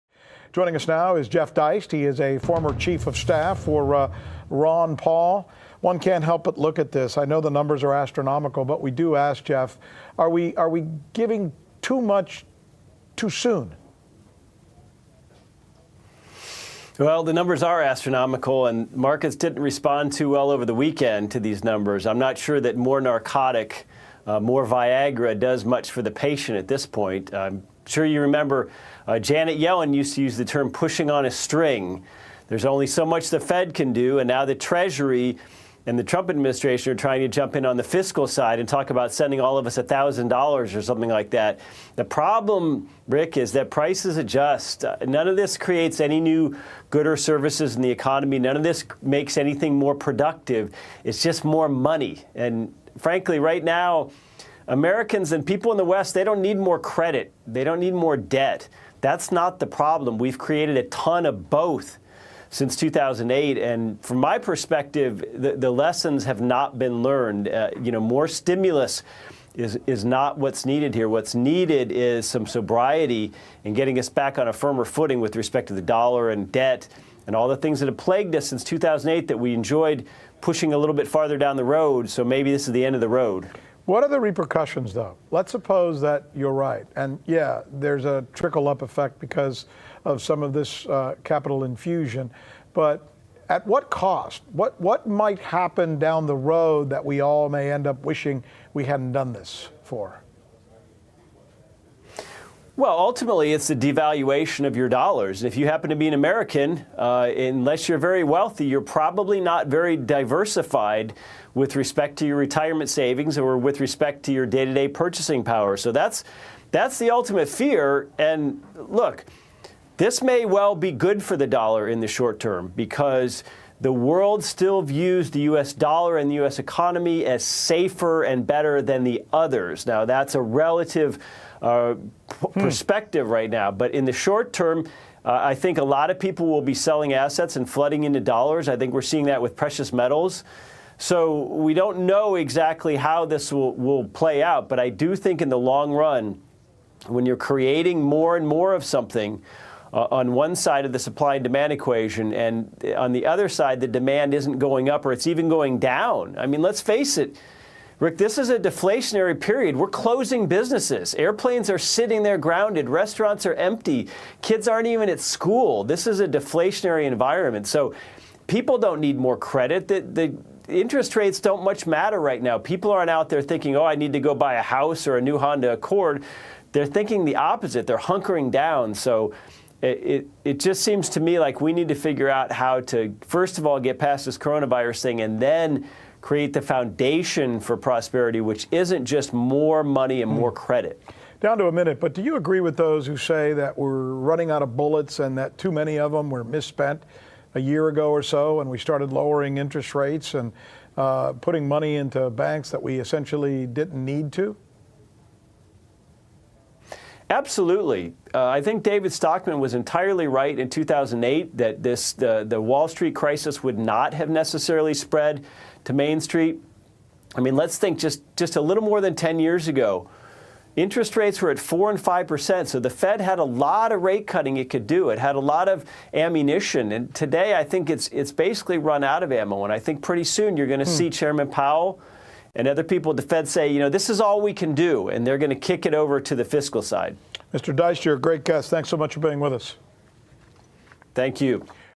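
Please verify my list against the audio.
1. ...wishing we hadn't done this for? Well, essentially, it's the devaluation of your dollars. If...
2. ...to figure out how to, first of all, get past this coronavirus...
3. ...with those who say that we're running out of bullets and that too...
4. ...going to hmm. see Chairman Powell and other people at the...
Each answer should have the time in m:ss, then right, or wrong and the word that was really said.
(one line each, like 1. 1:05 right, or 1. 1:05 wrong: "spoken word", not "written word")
1. 1:38 wrong: "ultimately", not "essentially"
2. 3:01 right
3. 3:12 right
4. 3:50 right.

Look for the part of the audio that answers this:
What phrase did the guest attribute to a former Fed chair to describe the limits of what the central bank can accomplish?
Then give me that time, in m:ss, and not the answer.
0:30.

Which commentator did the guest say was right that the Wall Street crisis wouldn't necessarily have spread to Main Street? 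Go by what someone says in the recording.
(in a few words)
David Stockman.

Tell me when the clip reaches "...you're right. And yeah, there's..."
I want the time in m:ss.
1:26.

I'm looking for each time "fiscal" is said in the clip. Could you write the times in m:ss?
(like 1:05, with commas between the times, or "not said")
0:37, 3:56.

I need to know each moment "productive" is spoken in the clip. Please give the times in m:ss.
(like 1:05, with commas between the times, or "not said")
0:49.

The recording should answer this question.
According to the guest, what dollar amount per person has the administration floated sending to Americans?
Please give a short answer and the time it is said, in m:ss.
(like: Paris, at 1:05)
$1,000, at 0:39.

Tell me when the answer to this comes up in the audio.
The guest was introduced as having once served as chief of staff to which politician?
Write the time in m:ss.
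0:04.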